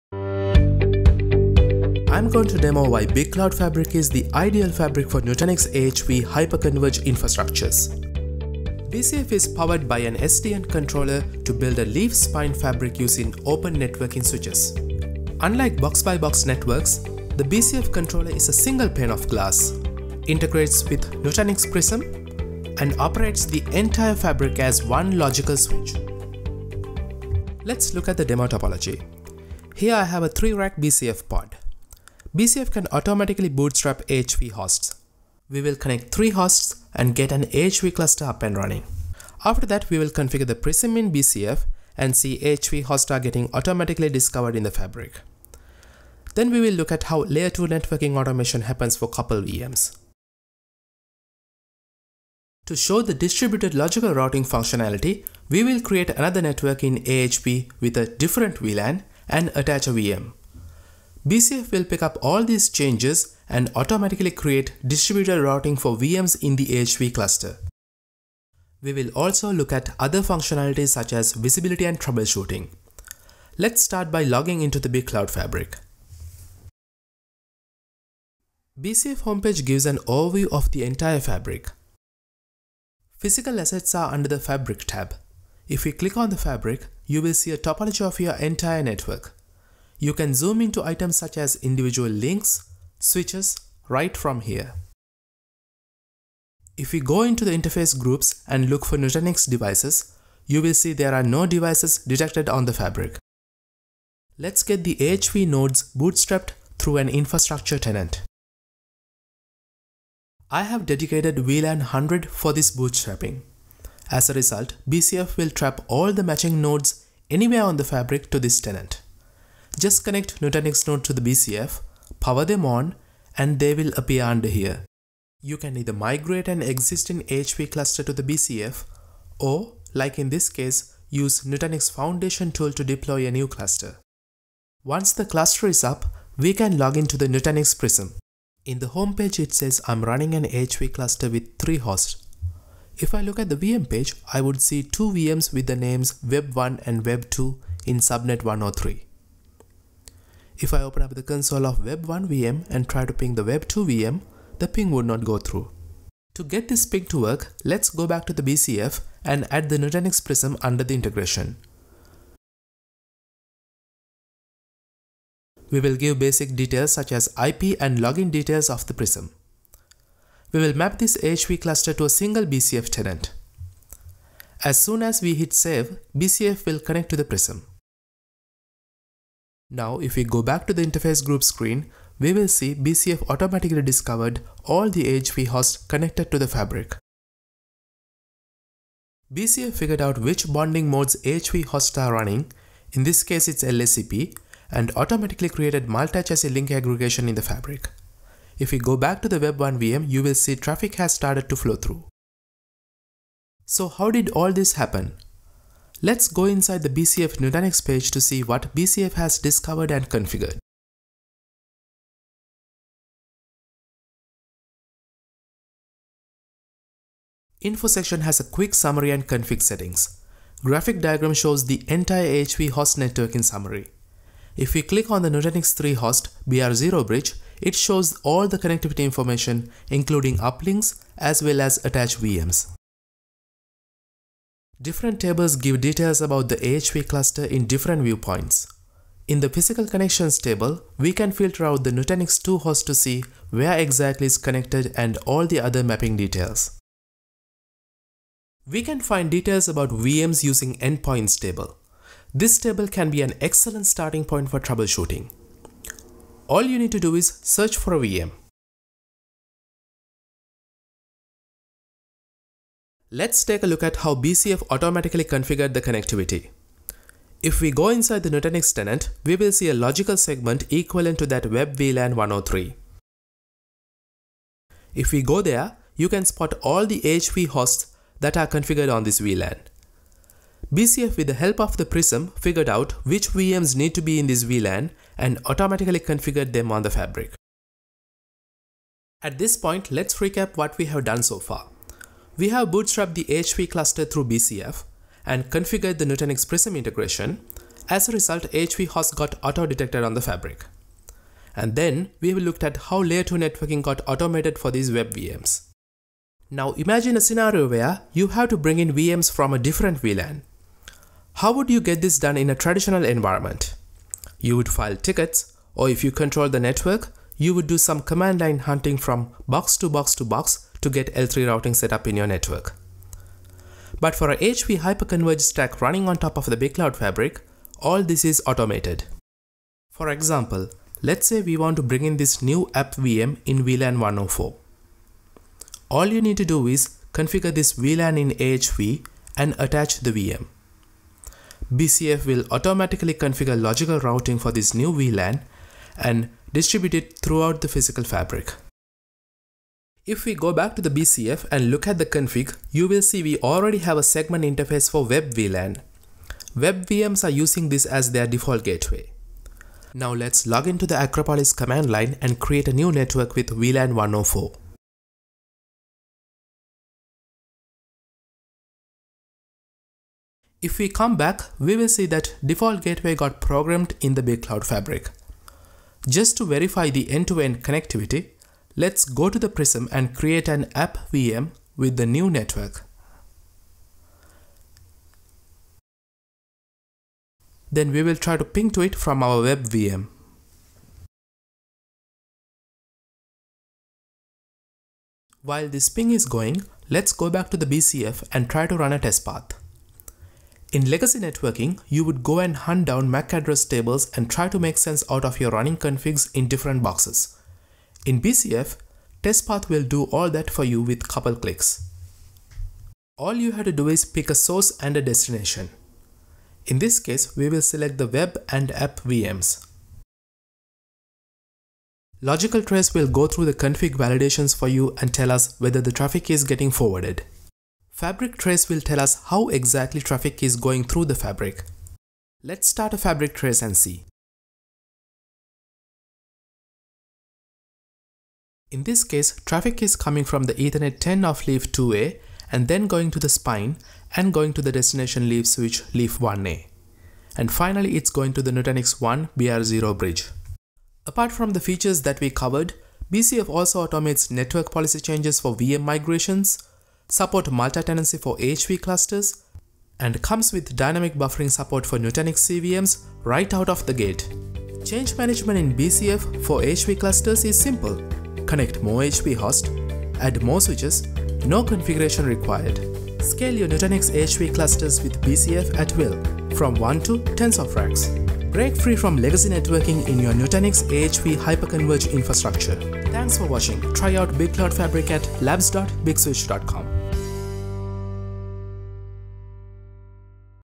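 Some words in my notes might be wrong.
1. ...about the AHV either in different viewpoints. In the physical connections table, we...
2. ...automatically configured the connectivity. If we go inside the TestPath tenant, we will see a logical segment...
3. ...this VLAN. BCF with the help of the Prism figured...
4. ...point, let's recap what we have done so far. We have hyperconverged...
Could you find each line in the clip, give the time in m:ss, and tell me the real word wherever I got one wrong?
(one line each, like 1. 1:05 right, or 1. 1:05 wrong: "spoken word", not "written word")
1. 3:56 wrong: "cluster", not "either"
2. 4:24 wrong: "Nutanix", not "TestPath"
3. 4:39 right
4. 4:49 wrong: "bootstrapped", not "hyperconverged".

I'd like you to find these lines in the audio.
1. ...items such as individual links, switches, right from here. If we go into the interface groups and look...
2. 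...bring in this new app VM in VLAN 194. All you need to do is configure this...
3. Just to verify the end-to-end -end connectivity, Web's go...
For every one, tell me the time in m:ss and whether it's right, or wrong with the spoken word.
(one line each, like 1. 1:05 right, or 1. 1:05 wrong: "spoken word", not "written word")
1. 1:30 right
2. 5:31 wrong: "104", not "194"
3. 6:16 wrong: "Let", not "Web".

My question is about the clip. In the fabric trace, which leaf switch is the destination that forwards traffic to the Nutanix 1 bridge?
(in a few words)
leaf 1A.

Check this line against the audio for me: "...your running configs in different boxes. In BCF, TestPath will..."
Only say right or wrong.
right.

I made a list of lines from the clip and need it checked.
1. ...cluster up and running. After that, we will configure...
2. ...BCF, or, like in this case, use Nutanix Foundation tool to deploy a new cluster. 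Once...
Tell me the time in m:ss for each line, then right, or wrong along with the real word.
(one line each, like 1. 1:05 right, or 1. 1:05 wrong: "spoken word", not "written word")
1. 0:37 right
2. 2:08 right.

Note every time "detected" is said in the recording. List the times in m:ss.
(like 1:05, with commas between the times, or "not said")
1:41, 4:59.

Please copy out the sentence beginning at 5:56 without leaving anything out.
Web VMs are using this as their default gateway.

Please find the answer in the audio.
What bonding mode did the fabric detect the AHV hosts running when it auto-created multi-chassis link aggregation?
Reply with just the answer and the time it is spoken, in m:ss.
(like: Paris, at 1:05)
LACP, at 3:13.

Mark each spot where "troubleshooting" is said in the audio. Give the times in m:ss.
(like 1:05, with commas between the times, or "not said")
1:11, 4:14.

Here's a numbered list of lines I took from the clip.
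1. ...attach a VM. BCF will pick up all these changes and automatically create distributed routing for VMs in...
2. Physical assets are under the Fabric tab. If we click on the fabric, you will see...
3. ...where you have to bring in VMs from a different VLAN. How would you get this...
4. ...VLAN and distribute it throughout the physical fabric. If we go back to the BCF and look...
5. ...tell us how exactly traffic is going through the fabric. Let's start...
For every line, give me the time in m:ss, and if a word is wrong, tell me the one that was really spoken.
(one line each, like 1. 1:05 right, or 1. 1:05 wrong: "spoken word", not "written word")
1. 0:59 right
2. 1:23 right
3. 5:07 right
4. 5:44 right
5. 7:08 right.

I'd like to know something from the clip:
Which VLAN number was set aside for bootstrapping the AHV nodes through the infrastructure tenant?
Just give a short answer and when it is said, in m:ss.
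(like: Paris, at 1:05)
100, at 1:51.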